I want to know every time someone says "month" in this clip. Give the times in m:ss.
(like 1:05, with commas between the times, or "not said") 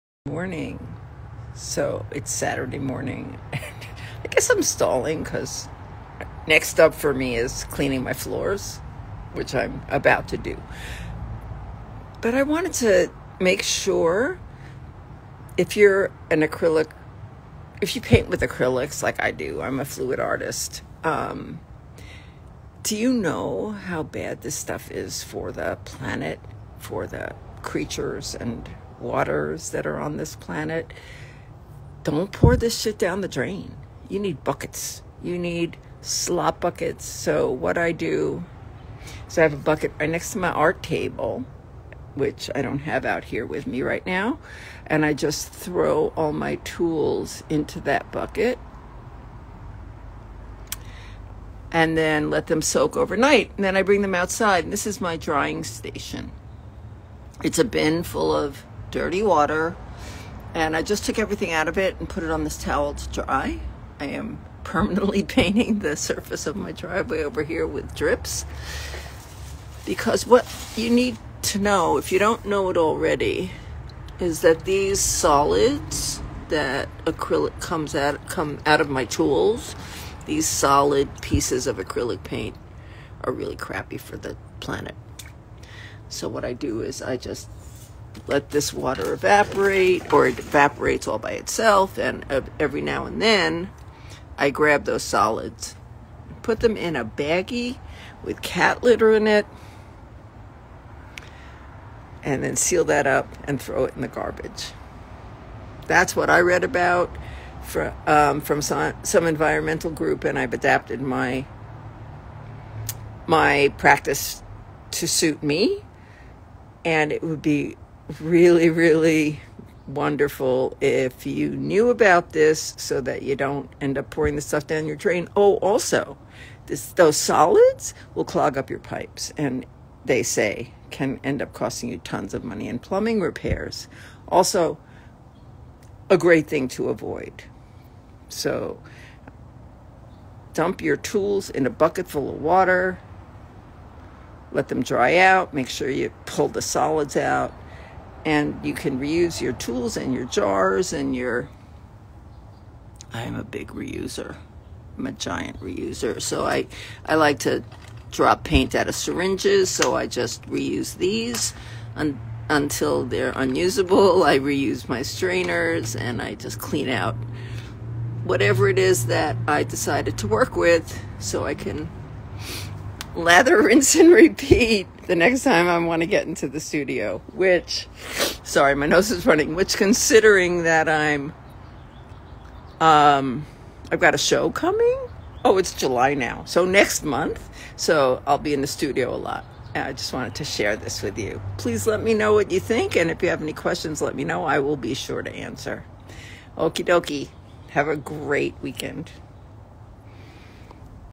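3:07.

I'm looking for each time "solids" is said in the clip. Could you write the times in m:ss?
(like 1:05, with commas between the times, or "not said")
1:14, 1:20, 1:35, 2:07, 2:26.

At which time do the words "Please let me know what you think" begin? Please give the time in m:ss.
3:11.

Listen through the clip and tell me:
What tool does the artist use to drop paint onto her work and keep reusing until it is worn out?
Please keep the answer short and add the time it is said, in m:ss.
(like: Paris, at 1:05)
syringes, at 2:38.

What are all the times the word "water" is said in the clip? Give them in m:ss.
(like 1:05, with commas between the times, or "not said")
0:29, 0:59, 1:28, 2:22.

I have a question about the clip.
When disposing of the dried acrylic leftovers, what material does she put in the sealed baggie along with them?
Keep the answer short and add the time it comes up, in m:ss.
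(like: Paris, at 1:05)
cat litter, at 1:38.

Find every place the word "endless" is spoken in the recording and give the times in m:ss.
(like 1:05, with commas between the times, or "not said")
not said.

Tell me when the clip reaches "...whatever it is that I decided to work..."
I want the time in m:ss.
2:48.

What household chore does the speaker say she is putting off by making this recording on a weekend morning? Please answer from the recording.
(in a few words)
cleaning my floors.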